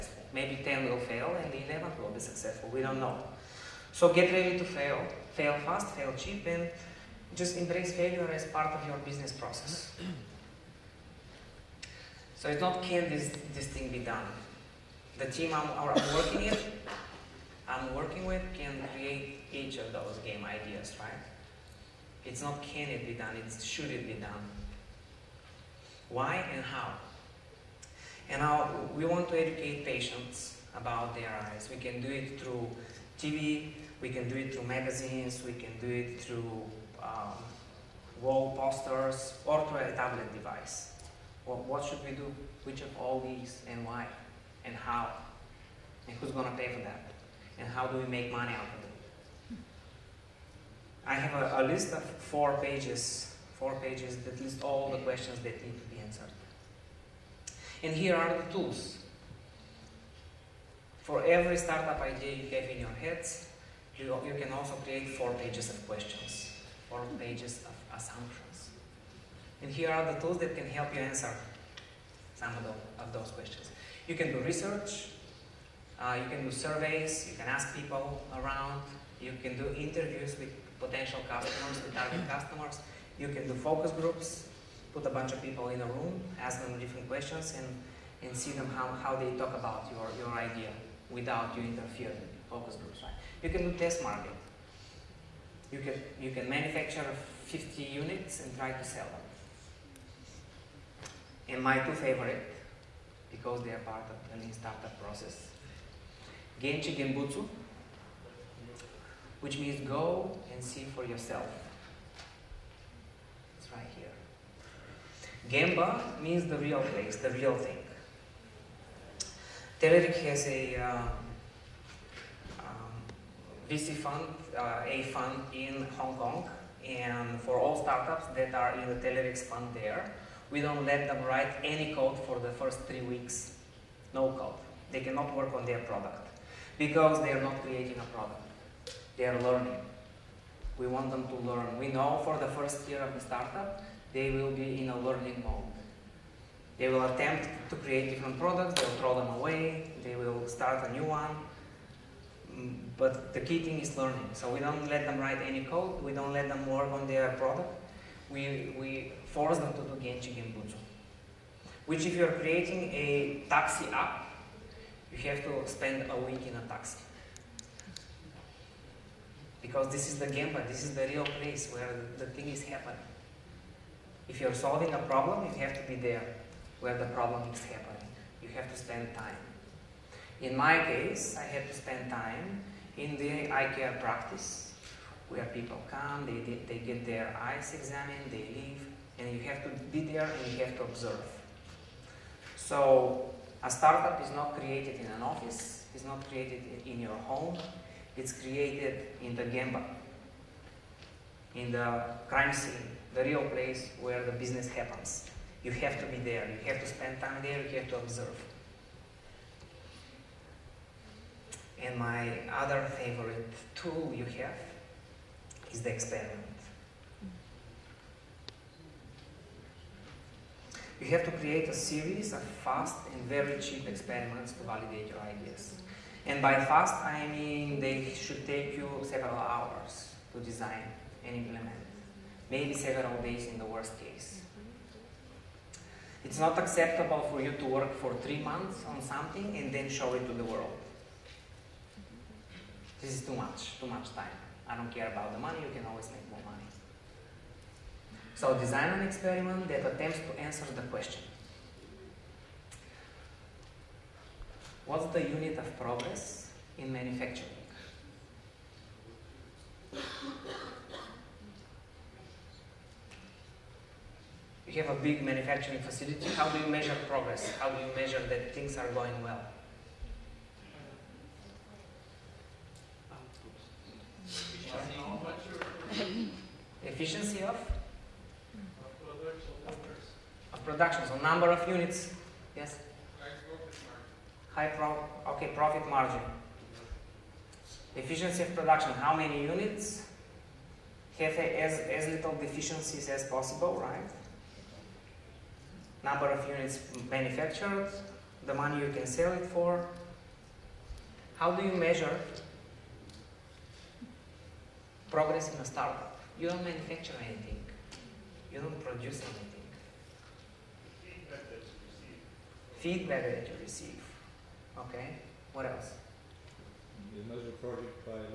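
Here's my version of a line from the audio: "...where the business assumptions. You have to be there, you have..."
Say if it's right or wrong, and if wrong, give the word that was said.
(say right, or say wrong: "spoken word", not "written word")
wrong: "happens", not "assumptions".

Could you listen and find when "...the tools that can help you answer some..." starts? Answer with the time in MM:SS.
01:10.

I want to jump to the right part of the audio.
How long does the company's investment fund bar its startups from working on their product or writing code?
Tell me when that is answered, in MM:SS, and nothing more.
02:12.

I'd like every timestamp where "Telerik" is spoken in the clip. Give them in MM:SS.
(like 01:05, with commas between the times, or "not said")
01:59, 02:08.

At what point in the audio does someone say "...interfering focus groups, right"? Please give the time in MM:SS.
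01:31.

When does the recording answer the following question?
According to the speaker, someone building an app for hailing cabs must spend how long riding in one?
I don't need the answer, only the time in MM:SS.
02:46.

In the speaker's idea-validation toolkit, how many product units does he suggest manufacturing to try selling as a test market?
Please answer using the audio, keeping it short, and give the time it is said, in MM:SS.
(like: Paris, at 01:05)
50, at 01:37.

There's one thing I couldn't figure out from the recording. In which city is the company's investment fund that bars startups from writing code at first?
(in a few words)
Hong Kong.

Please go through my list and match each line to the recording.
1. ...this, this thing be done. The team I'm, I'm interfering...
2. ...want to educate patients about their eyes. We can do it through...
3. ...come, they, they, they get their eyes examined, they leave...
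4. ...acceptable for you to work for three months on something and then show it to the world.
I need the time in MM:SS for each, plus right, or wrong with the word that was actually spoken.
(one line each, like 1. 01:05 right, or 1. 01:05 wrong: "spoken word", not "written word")
1. 00:13 wrong: "working", not "interfering"
2. 00:29 right
3. 03:05 right
4. 03:56 right.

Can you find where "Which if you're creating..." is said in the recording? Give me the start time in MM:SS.
02:41.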